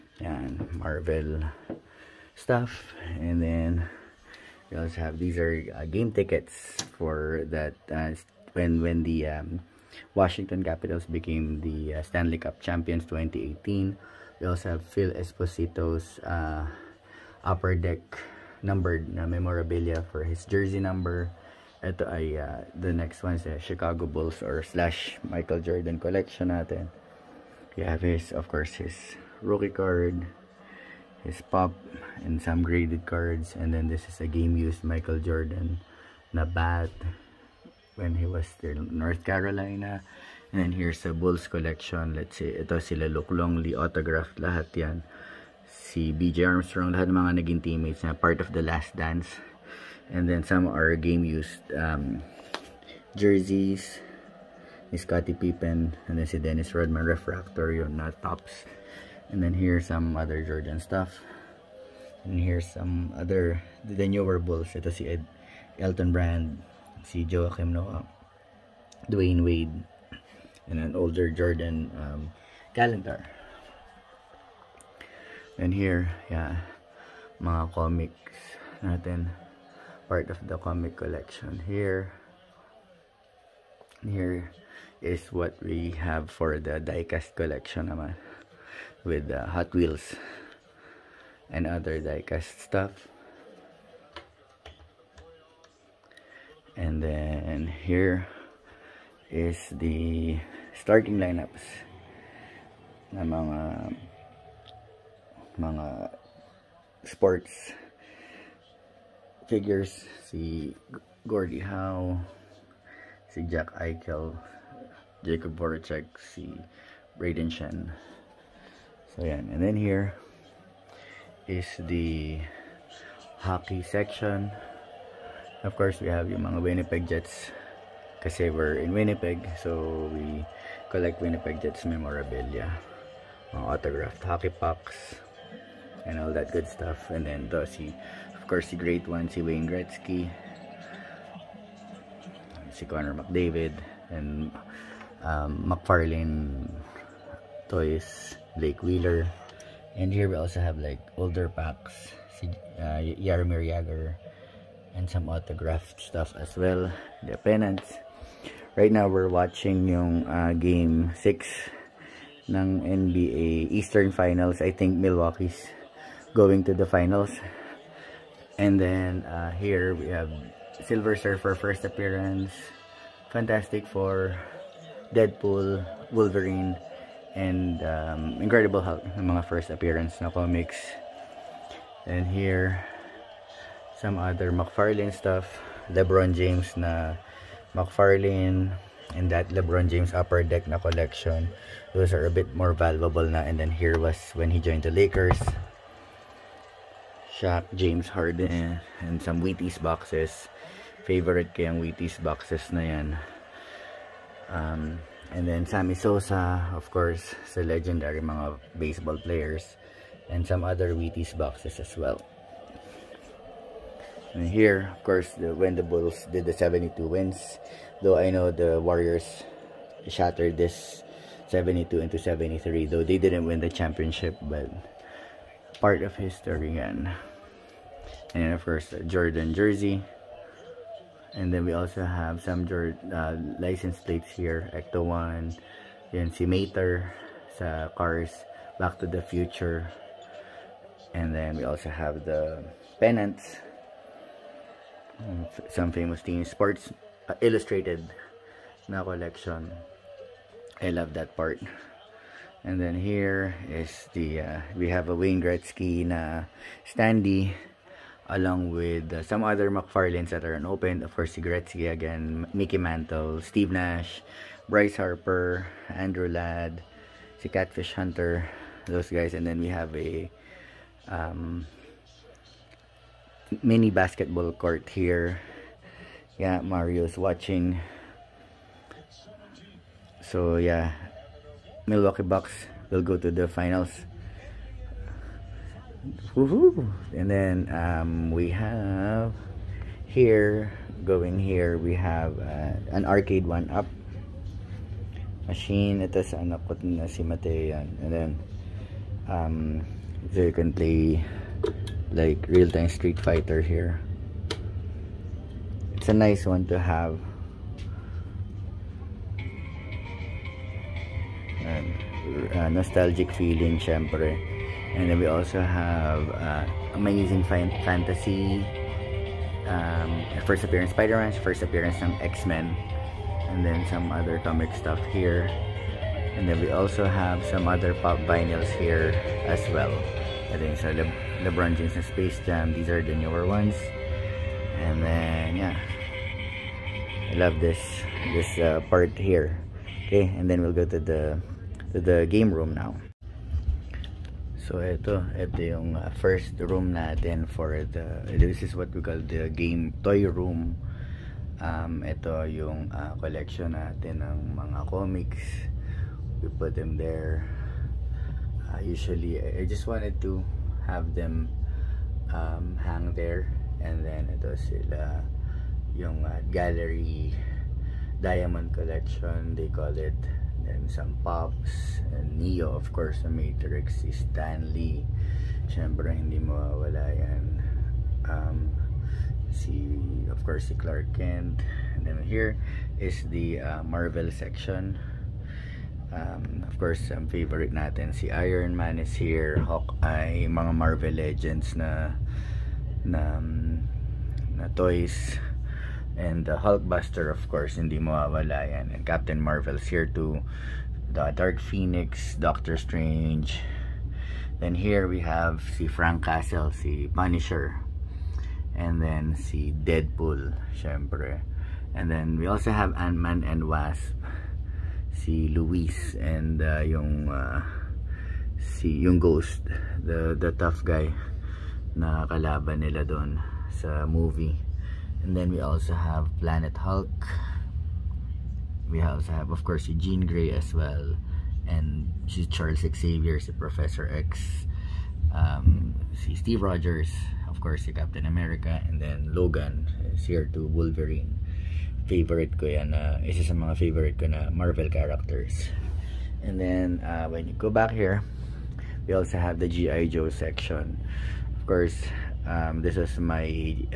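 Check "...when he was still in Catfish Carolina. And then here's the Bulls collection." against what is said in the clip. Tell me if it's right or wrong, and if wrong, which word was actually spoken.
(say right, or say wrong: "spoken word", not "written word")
wrong: "North", not "Catfish".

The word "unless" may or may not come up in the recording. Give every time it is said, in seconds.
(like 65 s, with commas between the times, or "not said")
not said.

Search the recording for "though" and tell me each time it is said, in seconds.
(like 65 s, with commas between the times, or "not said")
218 s, 222 s.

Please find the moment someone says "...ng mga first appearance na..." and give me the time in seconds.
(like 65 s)
179 s.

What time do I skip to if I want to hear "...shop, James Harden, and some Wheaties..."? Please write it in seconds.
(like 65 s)
197 s.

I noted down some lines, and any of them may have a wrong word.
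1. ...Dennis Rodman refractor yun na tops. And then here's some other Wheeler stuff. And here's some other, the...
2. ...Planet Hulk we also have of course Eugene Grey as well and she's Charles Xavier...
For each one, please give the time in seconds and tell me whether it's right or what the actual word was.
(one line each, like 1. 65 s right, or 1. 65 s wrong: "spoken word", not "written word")
1. 56 s wrong: "Jordan", not "Wheeler"
2. 426 s right.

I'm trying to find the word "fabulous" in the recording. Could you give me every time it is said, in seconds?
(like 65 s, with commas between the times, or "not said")
not said.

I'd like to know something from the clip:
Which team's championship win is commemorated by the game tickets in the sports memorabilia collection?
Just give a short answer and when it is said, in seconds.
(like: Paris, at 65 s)
Washington Capitals, at 10 s.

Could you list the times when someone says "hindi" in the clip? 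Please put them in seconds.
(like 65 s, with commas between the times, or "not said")
376 s, 397 s.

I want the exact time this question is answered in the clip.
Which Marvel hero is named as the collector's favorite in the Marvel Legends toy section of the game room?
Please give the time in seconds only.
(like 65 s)
388 s.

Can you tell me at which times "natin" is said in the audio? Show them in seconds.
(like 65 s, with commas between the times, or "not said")
26 s, 78 s, 346 s, 353 s, 387 s.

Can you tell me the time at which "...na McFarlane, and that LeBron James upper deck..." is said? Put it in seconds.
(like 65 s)
186 s.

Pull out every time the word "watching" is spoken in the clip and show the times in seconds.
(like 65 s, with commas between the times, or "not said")
159 s, 277 s.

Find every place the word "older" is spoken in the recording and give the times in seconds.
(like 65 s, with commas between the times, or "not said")
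70 s, 151 s.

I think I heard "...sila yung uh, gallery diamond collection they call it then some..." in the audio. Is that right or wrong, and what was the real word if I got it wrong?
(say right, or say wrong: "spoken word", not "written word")
right.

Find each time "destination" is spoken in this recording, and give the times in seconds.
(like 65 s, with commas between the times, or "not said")
not said.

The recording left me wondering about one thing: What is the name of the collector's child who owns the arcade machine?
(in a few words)
Mateo.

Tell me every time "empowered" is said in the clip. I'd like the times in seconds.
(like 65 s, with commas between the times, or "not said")
not said.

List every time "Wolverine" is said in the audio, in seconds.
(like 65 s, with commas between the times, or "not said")
176 s, 440 s.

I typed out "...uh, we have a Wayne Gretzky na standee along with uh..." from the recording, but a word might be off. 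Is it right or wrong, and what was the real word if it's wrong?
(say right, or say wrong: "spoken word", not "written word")
right.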